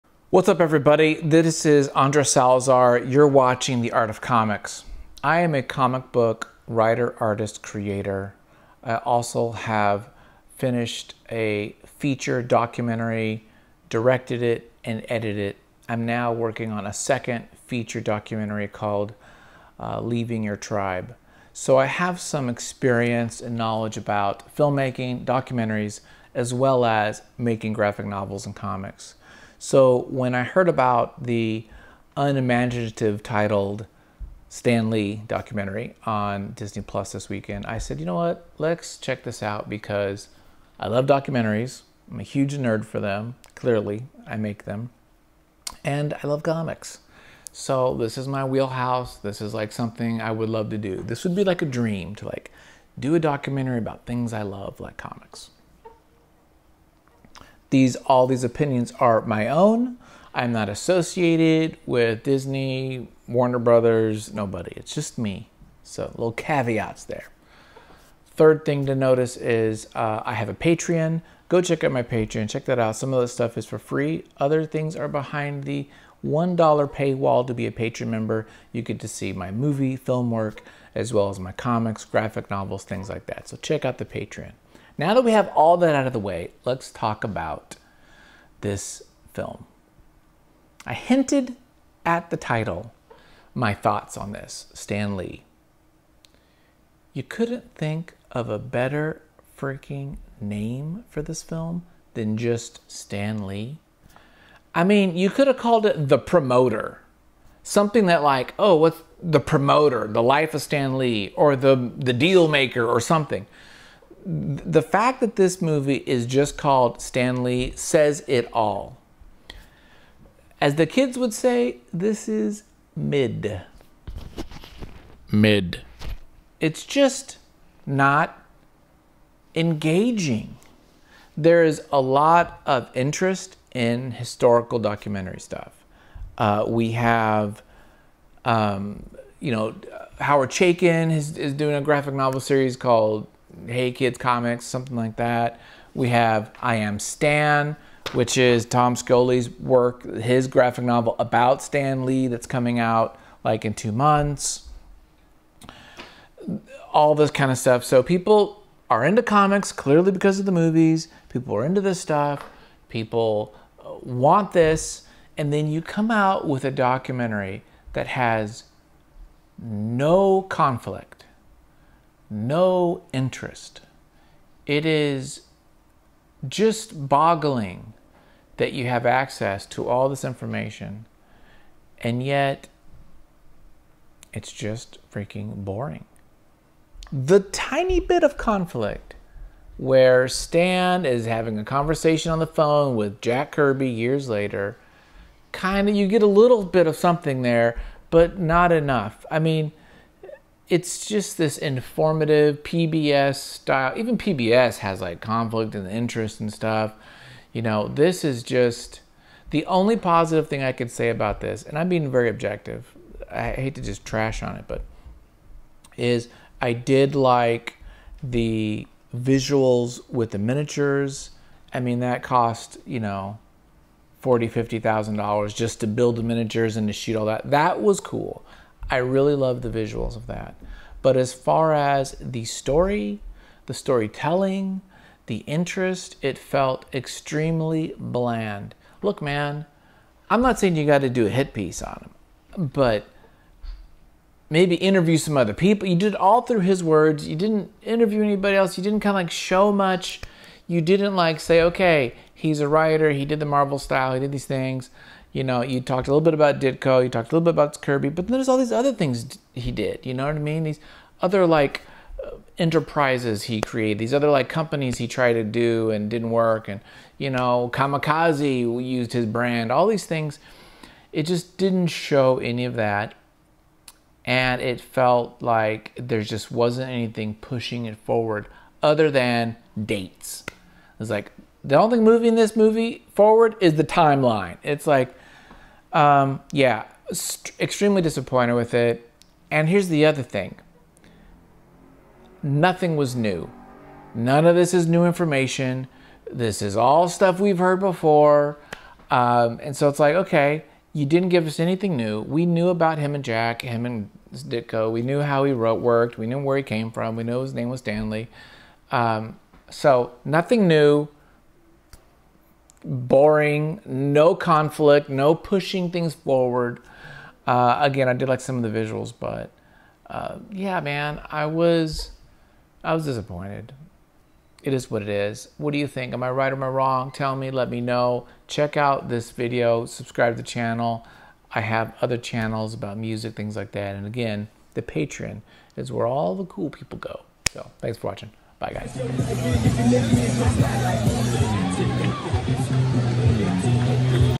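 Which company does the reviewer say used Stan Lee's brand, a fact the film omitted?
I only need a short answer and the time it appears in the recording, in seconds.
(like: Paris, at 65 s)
Kamikaze, at 267 s.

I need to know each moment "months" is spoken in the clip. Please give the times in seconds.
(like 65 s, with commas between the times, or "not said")
153 s.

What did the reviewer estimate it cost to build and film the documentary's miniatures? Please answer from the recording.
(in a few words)
40,000 to 50,000 dollars.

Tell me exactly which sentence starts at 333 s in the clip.
And again, the Patreon is where all the cool people go.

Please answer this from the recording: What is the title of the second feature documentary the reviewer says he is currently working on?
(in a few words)
Leaving Your Tribe.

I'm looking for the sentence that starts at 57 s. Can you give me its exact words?
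These all these opinions are my own.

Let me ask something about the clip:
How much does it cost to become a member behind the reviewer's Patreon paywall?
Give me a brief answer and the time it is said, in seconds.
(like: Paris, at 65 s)
$1, at 76 s.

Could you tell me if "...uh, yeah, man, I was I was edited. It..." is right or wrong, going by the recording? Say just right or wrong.
wrong.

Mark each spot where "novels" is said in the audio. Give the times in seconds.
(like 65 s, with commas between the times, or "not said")
28 s, 82 s, 142 s, 150 s.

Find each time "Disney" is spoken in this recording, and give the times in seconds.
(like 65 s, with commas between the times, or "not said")
36 s, 62 s.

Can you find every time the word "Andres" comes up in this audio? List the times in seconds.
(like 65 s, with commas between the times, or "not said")
1 s.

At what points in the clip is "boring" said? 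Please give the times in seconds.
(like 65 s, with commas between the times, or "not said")
185 s, 312 s.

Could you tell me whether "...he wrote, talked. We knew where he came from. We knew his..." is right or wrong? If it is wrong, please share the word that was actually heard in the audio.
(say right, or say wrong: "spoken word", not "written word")
wrong: "worked", not "talked".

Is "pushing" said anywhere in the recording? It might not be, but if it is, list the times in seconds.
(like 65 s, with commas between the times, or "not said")
277 s, 315 s.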